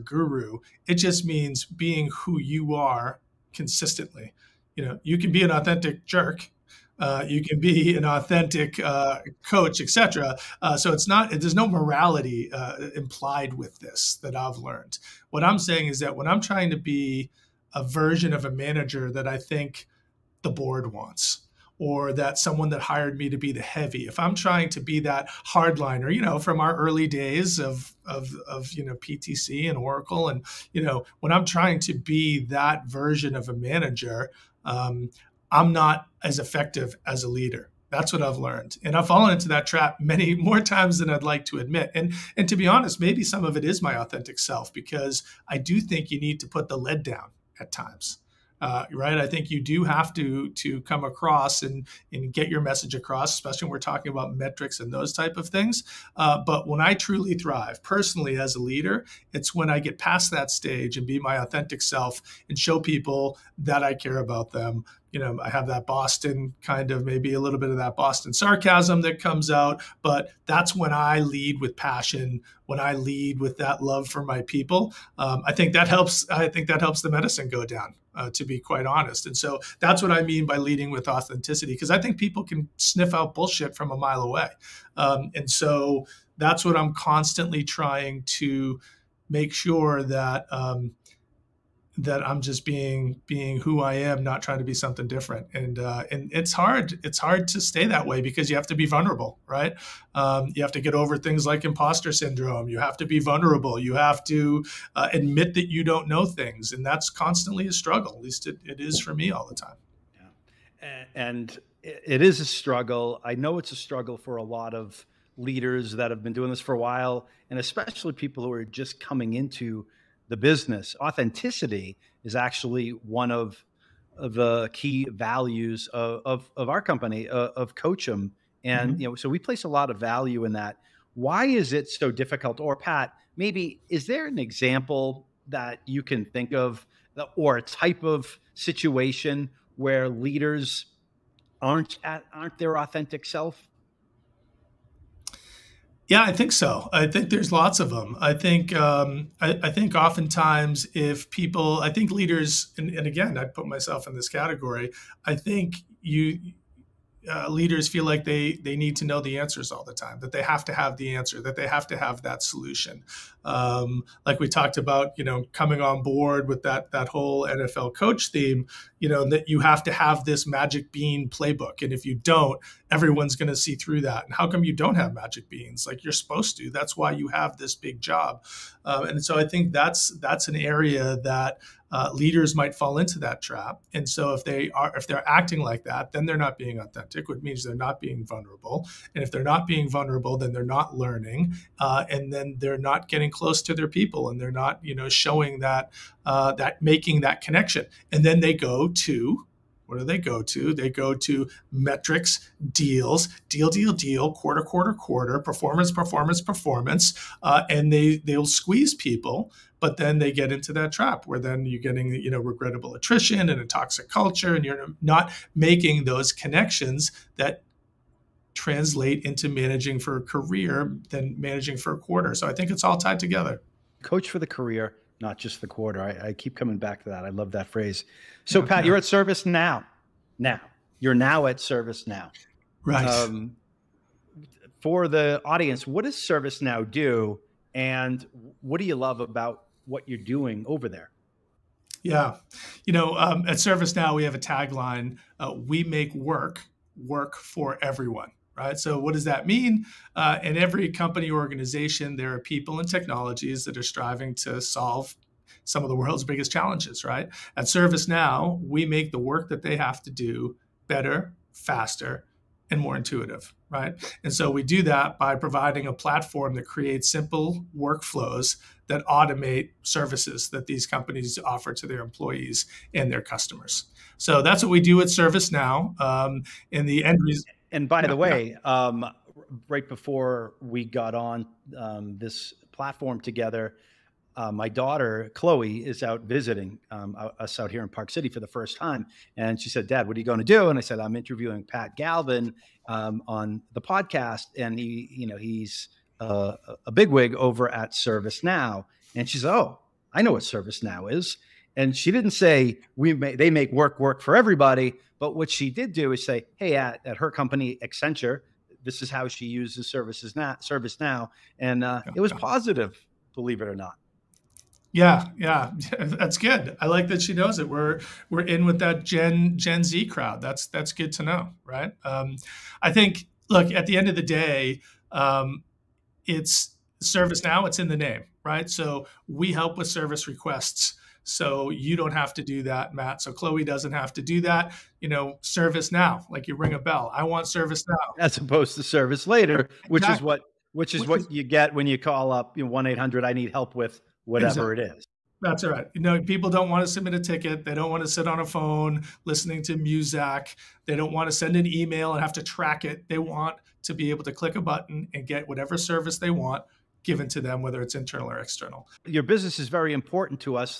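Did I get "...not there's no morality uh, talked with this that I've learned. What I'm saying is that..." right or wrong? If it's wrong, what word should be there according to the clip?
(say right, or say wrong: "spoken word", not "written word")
wrong: "implied", not "talked".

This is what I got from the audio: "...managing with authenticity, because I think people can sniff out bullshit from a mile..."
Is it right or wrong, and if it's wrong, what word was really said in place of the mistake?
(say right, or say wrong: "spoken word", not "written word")
wrong: "leading", not "managing".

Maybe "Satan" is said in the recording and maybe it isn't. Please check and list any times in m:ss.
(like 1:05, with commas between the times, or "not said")
not said.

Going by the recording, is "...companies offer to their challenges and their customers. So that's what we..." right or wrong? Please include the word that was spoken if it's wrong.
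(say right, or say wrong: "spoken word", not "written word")
wrong: "employees", not "challenges".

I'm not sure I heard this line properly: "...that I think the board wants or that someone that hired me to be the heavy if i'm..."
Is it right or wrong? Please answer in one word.
right.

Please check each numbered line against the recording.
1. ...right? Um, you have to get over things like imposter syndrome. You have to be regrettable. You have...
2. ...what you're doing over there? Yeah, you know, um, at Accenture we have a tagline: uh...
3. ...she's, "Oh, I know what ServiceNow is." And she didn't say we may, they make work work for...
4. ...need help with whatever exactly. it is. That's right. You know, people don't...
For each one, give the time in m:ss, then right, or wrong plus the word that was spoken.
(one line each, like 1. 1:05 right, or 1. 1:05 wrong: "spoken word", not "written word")
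1. 1:39 wrong: "vulnerable", not "regrettable"
2. 3:59 wrong: "ServiceNow", not "Accenture"
3. 4:59 right
4. 5:43 right.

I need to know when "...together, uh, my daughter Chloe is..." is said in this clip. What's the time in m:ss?
4:43.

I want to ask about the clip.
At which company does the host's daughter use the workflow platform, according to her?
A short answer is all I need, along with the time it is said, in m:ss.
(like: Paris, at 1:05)
Accenture, at 5:07.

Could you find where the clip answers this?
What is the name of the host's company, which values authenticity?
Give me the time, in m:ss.
2:07.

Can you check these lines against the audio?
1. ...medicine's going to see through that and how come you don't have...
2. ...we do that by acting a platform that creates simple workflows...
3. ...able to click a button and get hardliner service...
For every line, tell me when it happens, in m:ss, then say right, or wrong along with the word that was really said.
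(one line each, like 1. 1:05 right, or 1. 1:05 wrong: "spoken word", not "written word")
1. 2:52 wrong: "everyone", not "medicine"
2. 4:24 wrong: "providing", not "acting"
3. 5:54 wrong: "whatever", not "hardliner".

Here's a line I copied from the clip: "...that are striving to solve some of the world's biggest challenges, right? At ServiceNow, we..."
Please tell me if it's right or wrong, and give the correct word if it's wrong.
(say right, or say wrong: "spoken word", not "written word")
right.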